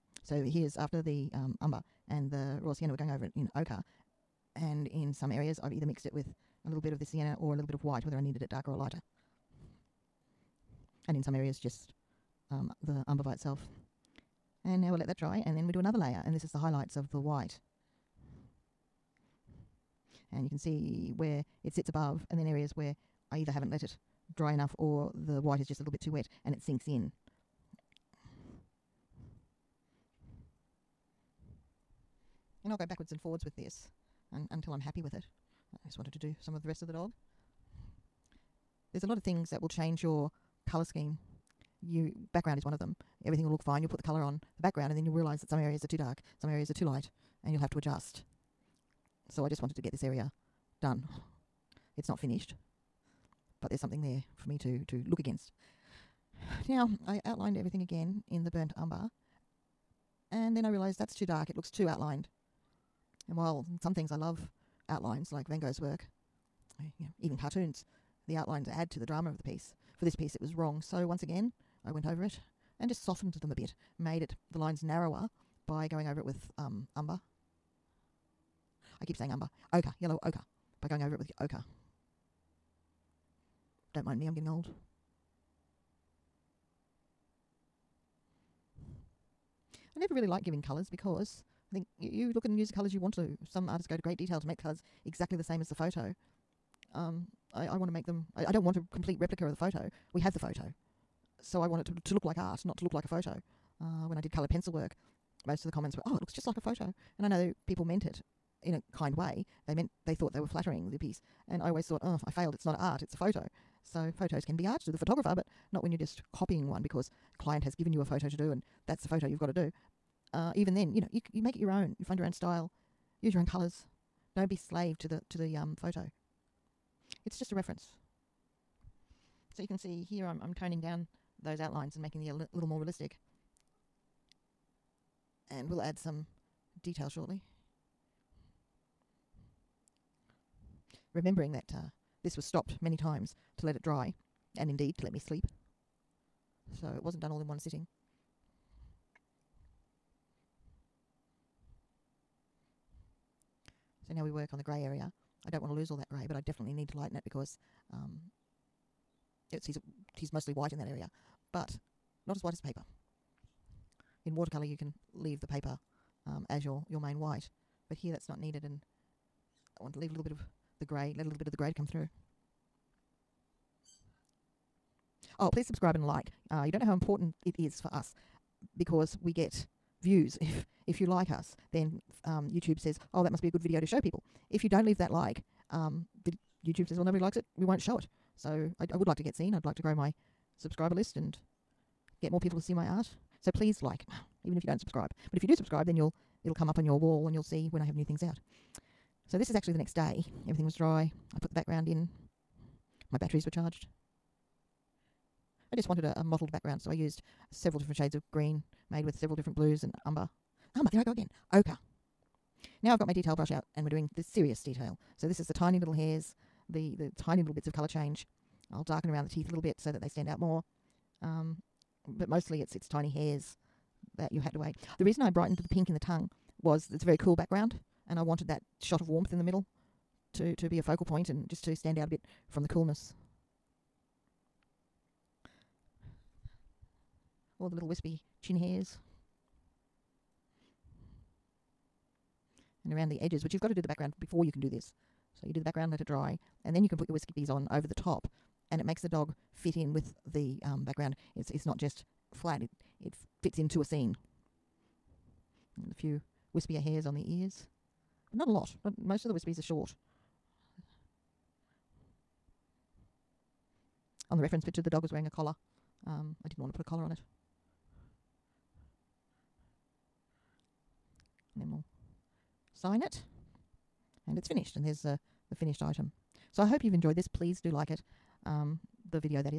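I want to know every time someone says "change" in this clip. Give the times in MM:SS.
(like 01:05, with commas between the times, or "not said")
00:39, 03:37.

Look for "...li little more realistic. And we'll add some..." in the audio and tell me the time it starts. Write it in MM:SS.
02:12.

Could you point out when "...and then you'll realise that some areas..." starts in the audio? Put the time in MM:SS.
00:44.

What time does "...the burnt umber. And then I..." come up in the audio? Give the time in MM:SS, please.
00:58.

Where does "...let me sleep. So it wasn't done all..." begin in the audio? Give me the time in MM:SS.
02:25.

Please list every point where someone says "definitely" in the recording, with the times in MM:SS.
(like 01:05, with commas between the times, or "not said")
02:36.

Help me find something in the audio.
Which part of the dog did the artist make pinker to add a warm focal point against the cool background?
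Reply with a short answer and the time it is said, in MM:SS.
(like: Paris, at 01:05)
The tongue, at 03:45.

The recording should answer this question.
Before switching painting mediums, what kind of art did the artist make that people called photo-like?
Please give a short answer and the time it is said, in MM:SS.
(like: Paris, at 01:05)
Coloured pencil, at 01:44.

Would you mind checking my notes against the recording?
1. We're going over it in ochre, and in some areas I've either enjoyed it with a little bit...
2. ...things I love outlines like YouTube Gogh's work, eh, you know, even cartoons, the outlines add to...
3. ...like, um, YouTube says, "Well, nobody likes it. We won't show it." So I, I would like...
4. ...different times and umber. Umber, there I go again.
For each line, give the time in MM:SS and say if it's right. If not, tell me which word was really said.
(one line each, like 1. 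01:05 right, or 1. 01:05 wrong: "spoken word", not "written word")
1. 00:02 wrong: "mixed", not "enjoyed"
2. 01:03 wrong: "Van", not "YouTube"
3. 03:05 right
4. 03:29 wrong: "blues", not "times".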